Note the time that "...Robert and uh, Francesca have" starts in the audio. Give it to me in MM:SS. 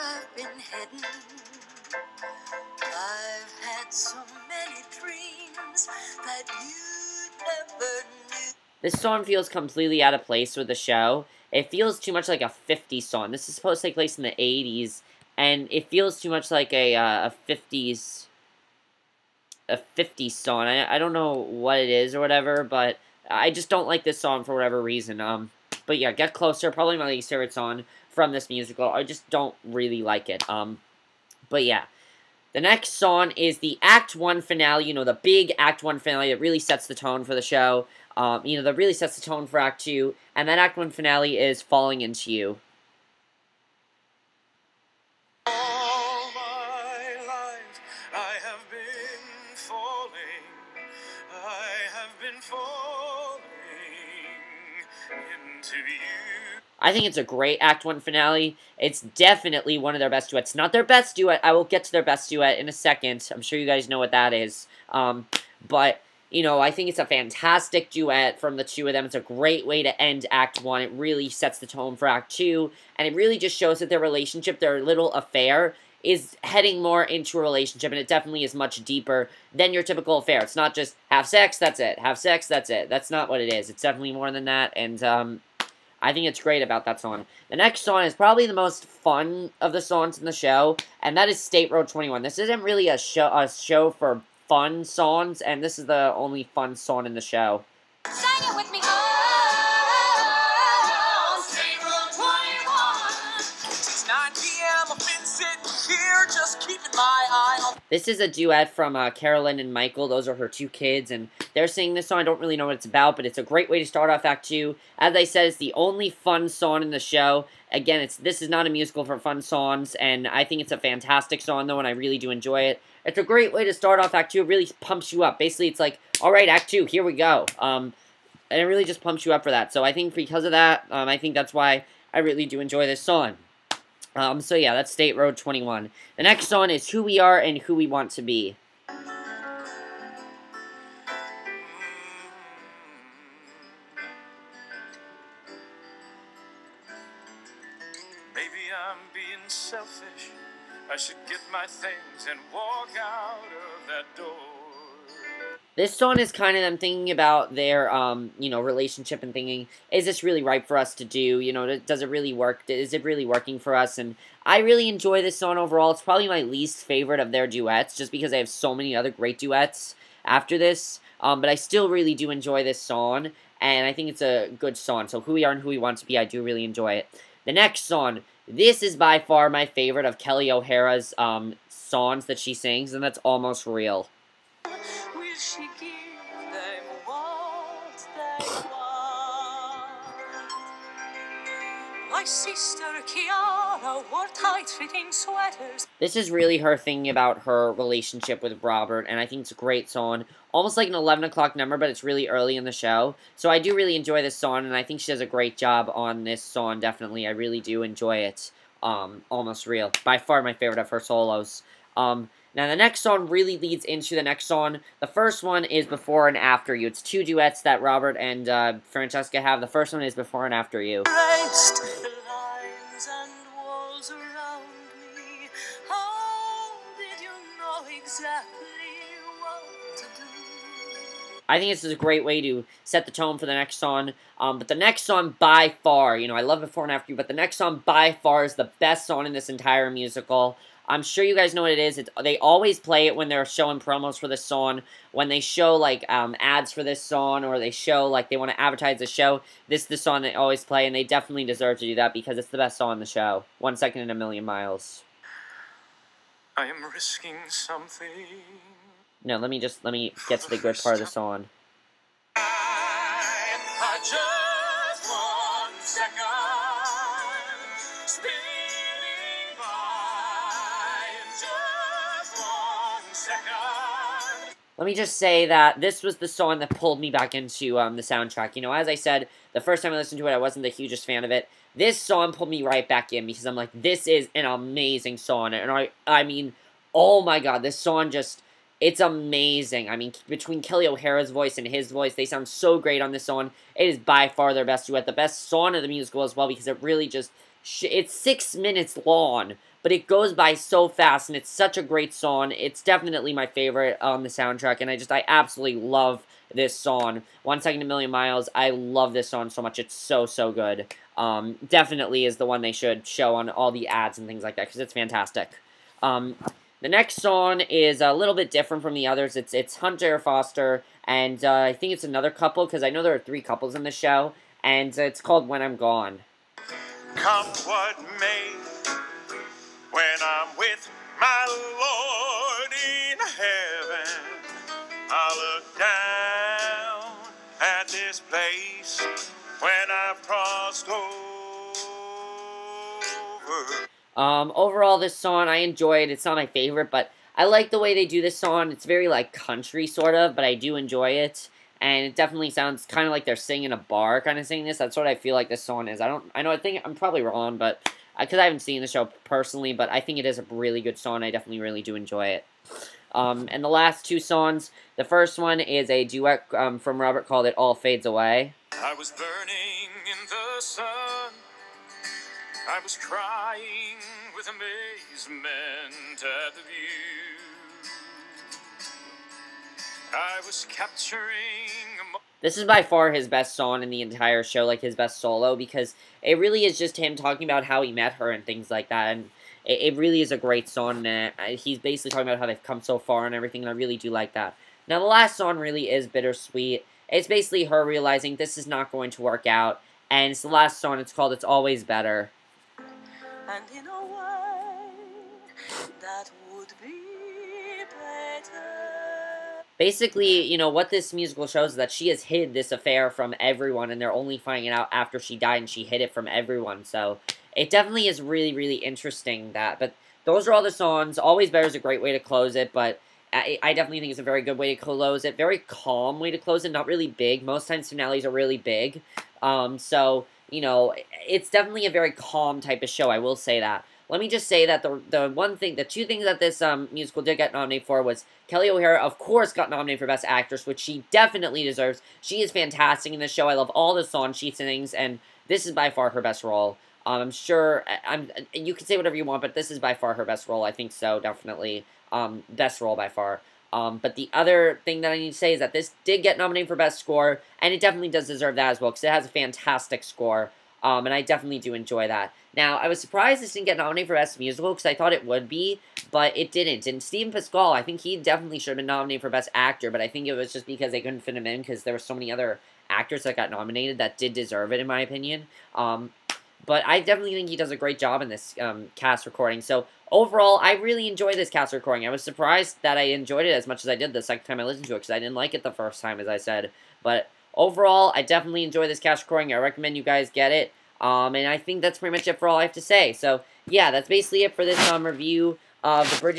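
03:37.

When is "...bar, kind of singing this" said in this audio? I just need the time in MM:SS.
05:53.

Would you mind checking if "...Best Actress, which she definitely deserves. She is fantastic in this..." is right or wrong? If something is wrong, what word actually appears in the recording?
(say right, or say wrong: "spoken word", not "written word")
right.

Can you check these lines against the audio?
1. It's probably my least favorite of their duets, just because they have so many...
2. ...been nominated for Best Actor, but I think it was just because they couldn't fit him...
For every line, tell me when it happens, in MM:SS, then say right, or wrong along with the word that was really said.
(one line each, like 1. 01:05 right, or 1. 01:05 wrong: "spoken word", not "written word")
1. 02:45 right
2. 07:48 right.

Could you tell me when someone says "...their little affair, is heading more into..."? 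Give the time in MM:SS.
01:14.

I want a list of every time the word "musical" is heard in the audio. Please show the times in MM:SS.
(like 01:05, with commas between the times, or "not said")
00:28, 01:58, 03:59, 04:55, 06:51, 07:16, 07:44.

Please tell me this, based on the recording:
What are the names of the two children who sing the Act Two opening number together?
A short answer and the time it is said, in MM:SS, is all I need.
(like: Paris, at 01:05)
Carolyn and Michael, at 01:49.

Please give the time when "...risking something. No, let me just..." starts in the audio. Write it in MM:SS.
04:16.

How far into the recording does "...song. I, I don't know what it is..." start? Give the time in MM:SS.
00:20.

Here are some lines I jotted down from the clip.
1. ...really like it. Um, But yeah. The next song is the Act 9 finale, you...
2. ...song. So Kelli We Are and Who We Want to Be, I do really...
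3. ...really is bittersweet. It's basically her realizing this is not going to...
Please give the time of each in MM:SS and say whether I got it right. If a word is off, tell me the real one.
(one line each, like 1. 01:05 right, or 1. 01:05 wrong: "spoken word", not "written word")
1. 00:29 wrong: "1", not "9"
2. 02:54 wrong: "Who", not "Kelli"
3. 06:35 right.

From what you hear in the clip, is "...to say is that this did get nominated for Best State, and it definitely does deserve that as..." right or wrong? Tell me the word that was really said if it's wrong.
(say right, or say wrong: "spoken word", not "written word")
wrong: "Score", not "State".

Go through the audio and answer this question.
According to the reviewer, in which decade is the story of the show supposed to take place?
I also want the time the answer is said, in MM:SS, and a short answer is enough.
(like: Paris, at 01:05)
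80s, at 00:14.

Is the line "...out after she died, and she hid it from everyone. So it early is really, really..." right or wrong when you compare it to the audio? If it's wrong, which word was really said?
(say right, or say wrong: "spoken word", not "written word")
wrong: "definitely", not "early".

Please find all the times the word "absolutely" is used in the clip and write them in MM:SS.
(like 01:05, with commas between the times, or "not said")
05:05.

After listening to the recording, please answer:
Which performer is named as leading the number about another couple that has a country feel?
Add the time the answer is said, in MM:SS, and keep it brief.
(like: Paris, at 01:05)
Hunter Foster, at 05:19.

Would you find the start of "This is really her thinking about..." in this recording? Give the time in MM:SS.
03:15.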